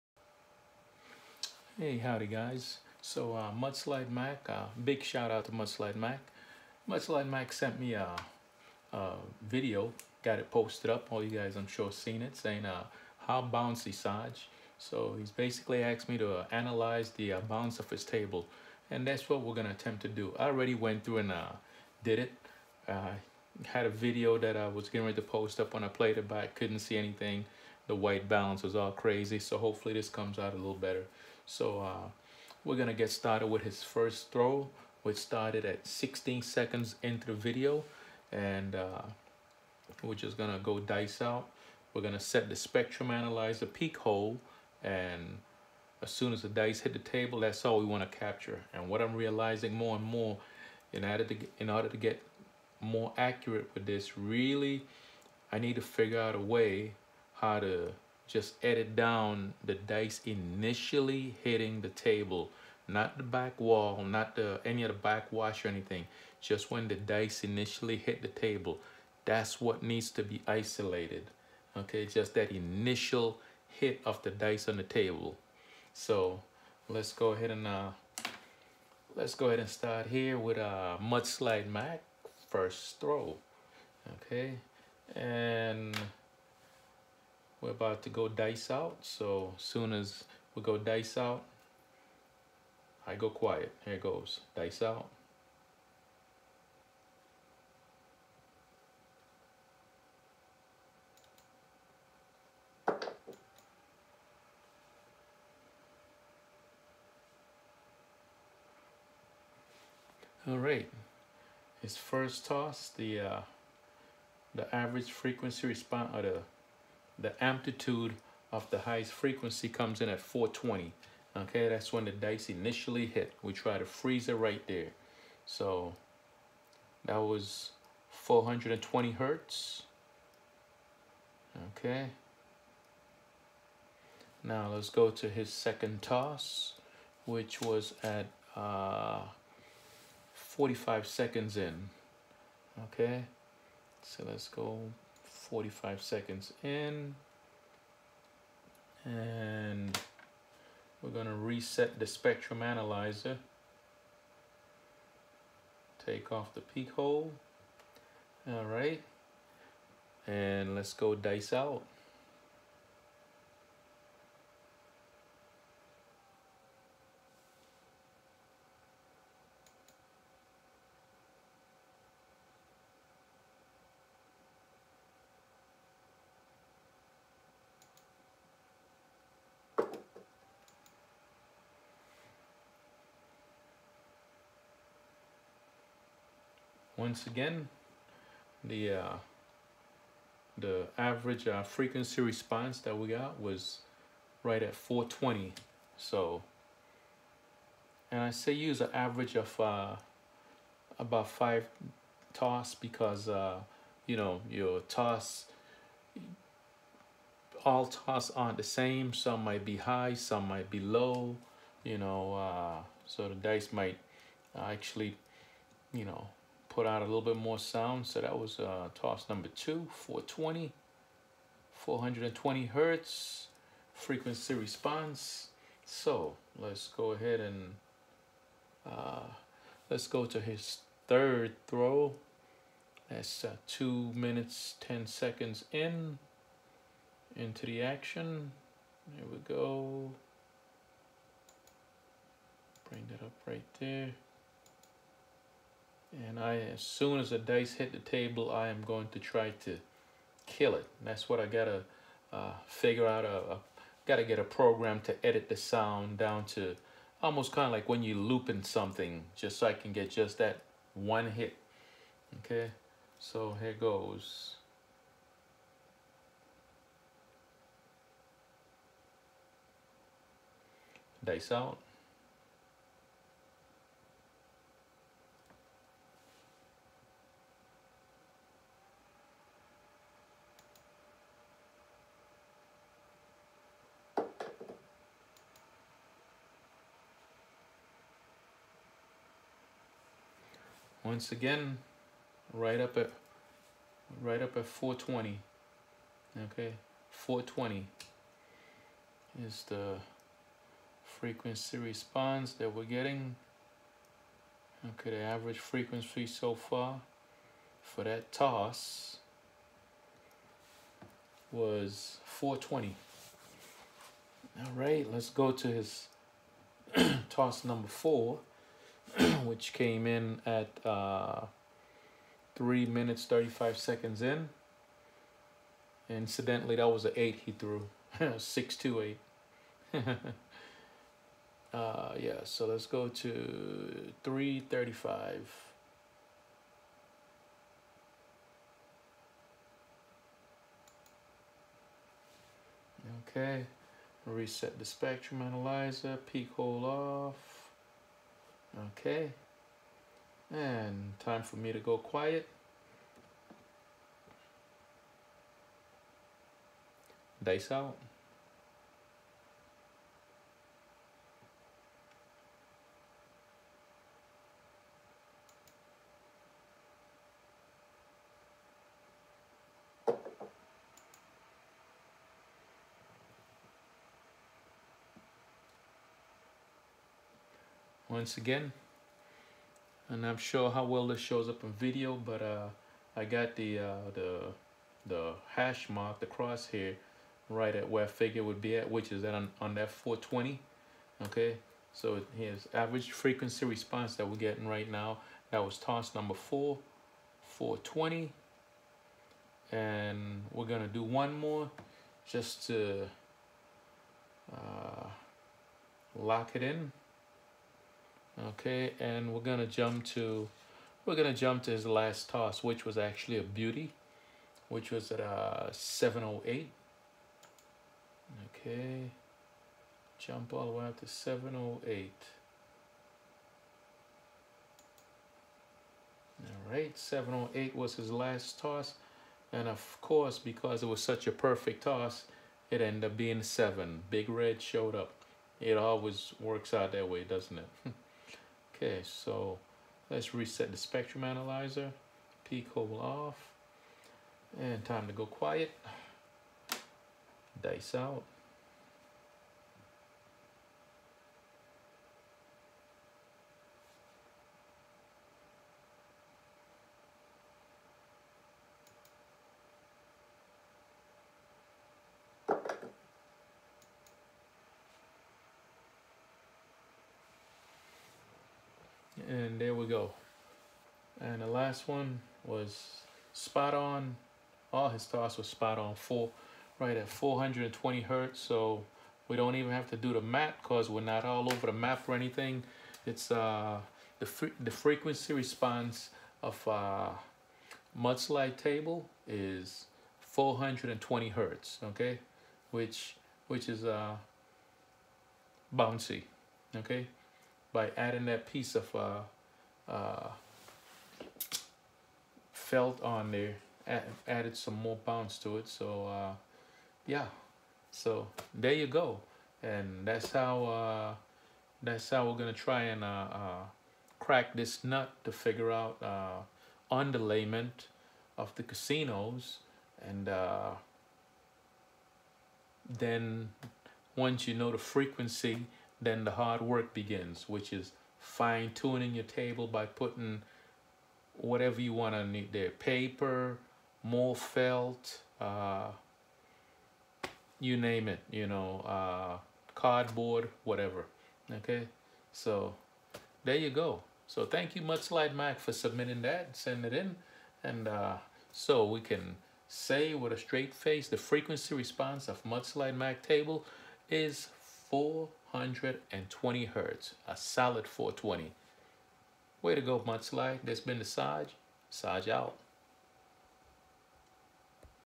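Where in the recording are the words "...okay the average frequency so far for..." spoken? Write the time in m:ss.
5:04.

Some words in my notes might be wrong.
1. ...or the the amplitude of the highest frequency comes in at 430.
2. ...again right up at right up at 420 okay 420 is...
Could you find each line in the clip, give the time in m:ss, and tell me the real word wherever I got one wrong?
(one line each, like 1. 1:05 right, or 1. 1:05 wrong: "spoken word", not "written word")
1. 1:56 wrong: "420", not "430"
2. 4:51 right.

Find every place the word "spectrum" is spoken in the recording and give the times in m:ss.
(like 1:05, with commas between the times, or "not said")
0:42, 2:32, 5:44, 7:20.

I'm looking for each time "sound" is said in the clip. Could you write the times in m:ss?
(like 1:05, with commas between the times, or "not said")
3:37, 4:15.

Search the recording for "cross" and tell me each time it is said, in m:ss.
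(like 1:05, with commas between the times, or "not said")
6:26.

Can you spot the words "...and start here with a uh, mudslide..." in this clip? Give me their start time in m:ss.
1:19.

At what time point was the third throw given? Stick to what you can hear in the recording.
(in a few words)
2 minutes 10 seconds.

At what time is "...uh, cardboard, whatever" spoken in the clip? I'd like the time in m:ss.
8:58.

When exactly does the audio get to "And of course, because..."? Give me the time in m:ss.
7:09.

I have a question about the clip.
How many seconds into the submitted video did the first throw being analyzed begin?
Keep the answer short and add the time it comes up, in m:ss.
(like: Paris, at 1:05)
16, at 0:35.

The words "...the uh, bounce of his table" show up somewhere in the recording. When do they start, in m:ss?
0:17.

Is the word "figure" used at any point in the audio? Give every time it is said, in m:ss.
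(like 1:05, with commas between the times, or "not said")
0:55, 4:12, 6:28, 8:35.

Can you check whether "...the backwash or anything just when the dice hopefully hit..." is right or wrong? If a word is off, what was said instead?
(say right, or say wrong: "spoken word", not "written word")
wrong: "initially", not "hopefully".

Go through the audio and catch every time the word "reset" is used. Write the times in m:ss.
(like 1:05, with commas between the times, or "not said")
2:31, 5:44, 7:20.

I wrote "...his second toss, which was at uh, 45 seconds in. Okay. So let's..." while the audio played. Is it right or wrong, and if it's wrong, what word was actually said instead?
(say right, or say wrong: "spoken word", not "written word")
right.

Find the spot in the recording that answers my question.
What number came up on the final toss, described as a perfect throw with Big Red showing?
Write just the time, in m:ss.
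7:13.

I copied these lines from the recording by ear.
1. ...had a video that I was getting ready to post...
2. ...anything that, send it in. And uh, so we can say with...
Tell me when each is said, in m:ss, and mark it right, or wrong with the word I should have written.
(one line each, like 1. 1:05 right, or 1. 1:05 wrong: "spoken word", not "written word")
1. 0:23 right
2. 9:05 wrong: "submitting", not "anything".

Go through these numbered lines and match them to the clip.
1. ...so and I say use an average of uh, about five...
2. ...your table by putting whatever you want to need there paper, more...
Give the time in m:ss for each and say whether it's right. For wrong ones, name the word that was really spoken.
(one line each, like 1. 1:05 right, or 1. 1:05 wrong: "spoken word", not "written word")
1. 3:15 right
2. 8:49 right.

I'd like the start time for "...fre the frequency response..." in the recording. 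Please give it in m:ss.
8:04.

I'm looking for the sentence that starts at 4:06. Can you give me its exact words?
And I, as soon as the dice hit the table, I am going to try to kill it.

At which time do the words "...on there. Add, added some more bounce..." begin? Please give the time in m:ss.
8:23.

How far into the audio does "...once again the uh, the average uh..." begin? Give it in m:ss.
3:07.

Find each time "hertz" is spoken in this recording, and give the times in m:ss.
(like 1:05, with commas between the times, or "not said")
2:09, 3:42, 7:58, 8:11, 9:16.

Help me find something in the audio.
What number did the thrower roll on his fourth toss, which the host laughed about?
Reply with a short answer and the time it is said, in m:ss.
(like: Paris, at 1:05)
8, at 5:27.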